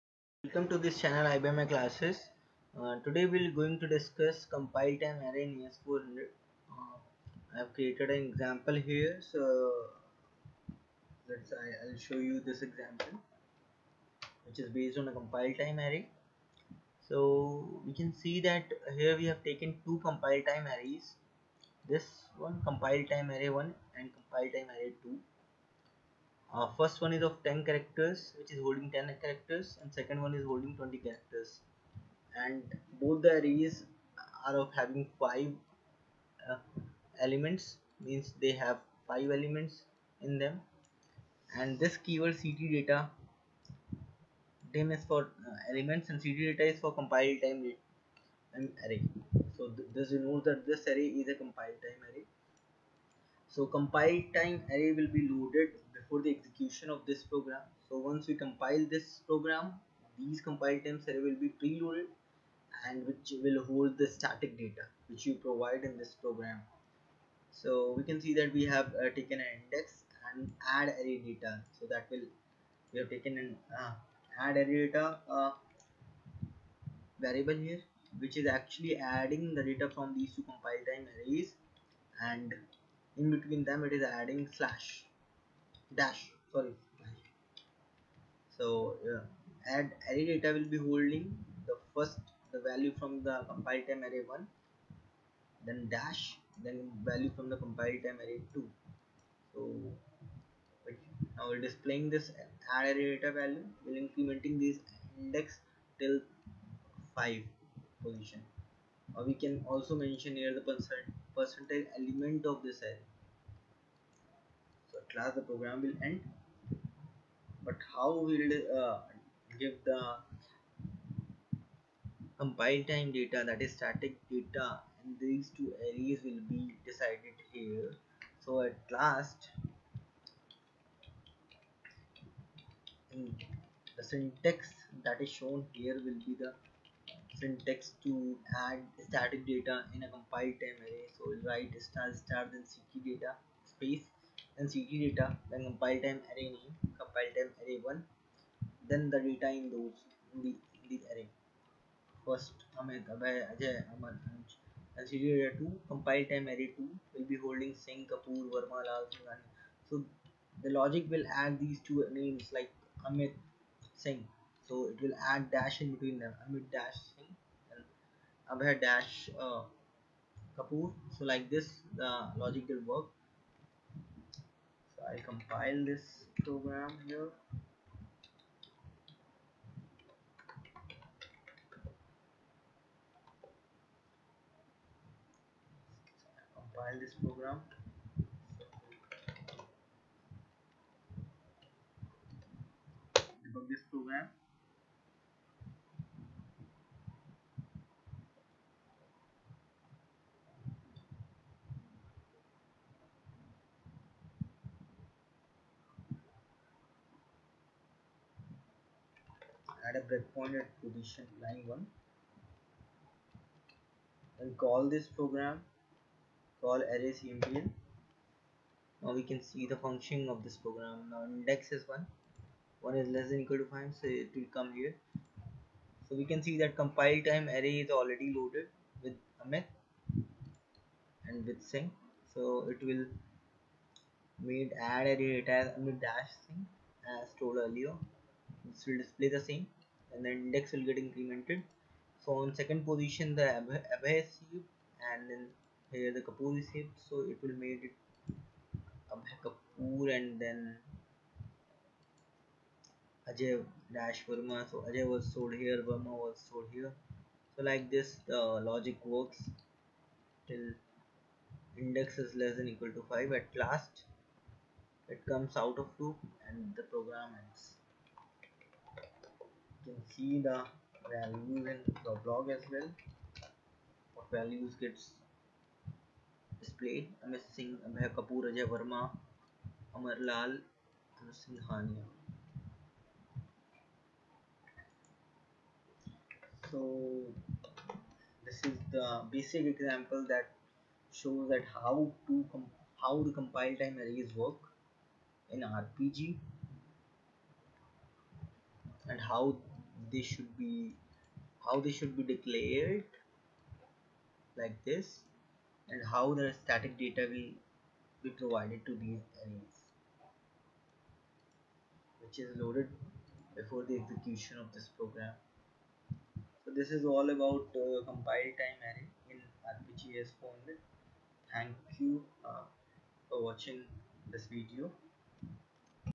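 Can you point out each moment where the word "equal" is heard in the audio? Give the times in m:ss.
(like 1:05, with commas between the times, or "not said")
3:43, 4:22.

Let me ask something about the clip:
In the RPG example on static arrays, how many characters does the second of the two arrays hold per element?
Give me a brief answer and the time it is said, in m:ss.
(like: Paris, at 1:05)
20, at 0:30.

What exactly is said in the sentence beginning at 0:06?
Uh, I have created an example here.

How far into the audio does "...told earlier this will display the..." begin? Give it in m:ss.
3:57.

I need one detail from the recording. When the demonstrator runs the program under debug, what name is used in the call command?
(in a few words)
array empl.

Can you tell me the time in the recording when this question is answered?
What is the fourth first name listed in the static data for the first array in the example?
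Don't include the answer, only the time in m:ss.
2:33.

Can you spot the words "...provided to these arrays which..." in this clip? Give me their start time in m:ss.
5:08.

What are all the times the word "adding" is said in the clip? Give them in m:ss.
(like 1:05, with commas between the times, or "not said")
1:19, 1:24.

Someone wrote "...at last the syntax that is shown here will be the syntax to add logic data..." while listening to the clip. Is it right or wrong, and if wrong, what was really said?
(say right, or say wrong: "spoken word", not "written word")
wrong: "static", not "logic".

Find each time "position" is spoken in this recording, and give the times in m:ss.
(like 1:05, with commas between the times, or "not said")
1:48, 3:30, 4:02.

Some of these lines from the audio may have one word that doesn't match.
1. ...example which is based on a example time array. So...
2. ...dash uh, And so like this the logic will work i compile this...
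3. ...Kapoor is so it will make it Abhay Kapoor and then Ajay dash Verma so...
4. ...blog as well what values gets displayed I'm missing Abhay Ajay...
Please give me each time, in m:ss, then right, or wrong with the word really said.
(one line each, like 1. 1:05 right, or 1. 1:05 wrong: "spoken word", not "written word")
1. 0:12 wrong: "compile", not "example"
2. 2:48 wrong: "Kapoor", not "And"
3. 4:06 right
4. 4:32 wrong: "Kapoor", not "Ajay".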